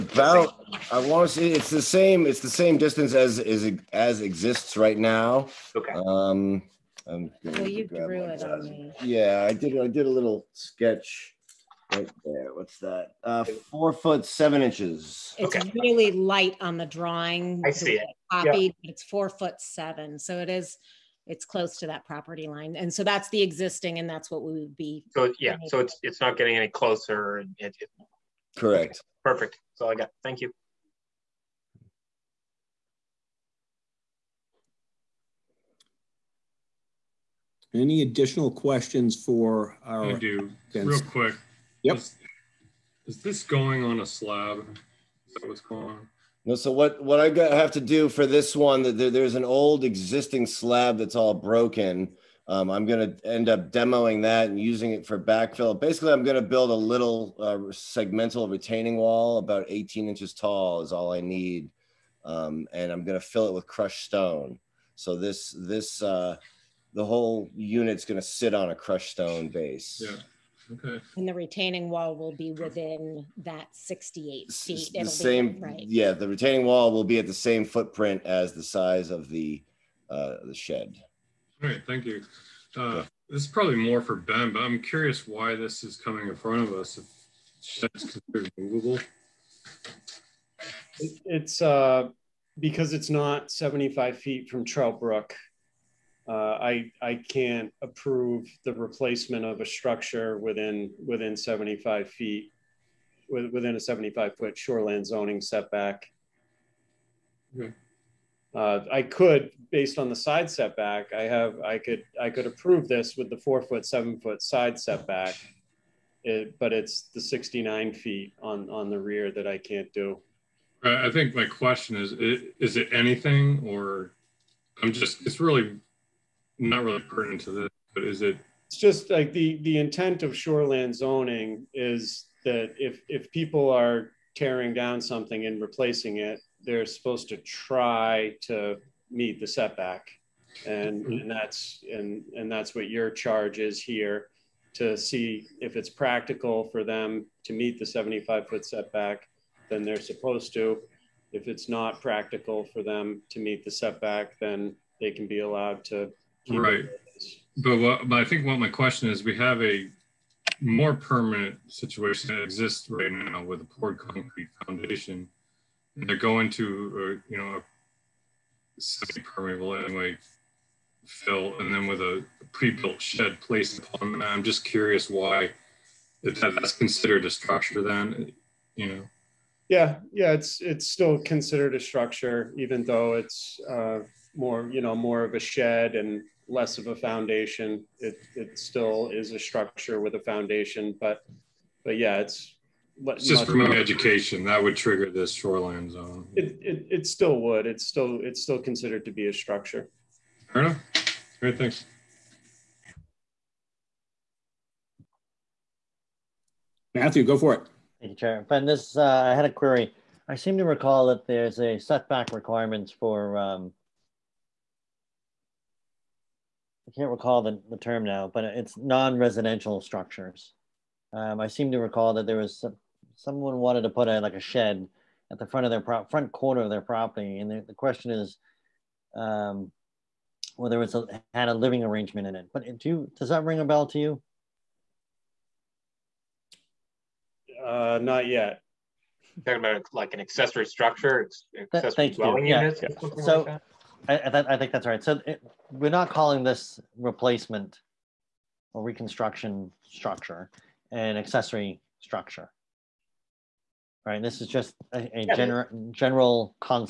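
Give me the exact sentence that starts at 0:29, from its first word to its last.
perfect that's all i got thank you any additional questions for our i do real quick Yep.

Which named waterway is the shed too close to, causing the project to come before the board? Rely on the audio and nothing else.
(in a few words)
Trout Brook.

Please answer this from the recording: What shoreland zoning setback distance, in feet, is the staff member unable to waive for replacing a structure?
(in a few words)
75 feet.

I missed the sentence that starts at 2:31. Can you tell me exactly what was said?
If it's not practical for them to meet the setback, then they can be allowed to Right.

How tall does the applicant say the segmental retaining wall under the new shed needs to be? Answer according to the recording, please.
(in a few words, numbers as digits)
18 inches.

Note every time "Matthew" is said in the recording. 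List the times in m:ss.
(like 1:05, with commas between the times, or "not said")
3:26.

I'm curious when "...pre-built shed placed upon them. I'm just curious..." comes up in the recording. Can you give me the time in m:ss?
2:52.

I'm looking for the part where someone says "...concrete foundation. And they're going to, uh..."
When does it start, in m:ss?
2:43.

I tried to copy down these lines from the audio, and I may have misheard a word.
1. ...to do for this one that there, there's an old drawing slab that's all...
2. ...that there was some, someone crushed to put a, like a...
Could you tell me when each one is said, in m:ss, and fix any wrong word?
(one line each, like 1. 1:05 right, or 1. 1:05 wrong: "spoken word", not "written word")
1. 0:47 wrong: "existing", not "drawing"
2. 3:42 wrong: "wanted", not "crushed".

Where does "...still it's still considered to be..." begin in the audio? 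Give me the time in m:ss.
3:17.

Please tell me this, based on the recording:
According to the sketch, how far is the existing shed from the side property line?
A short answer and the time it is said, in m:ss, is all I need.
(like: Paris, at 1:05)
4 feet 7 inches, at 0:13.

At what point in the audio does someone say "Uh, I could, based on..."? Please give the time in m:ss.
1:48.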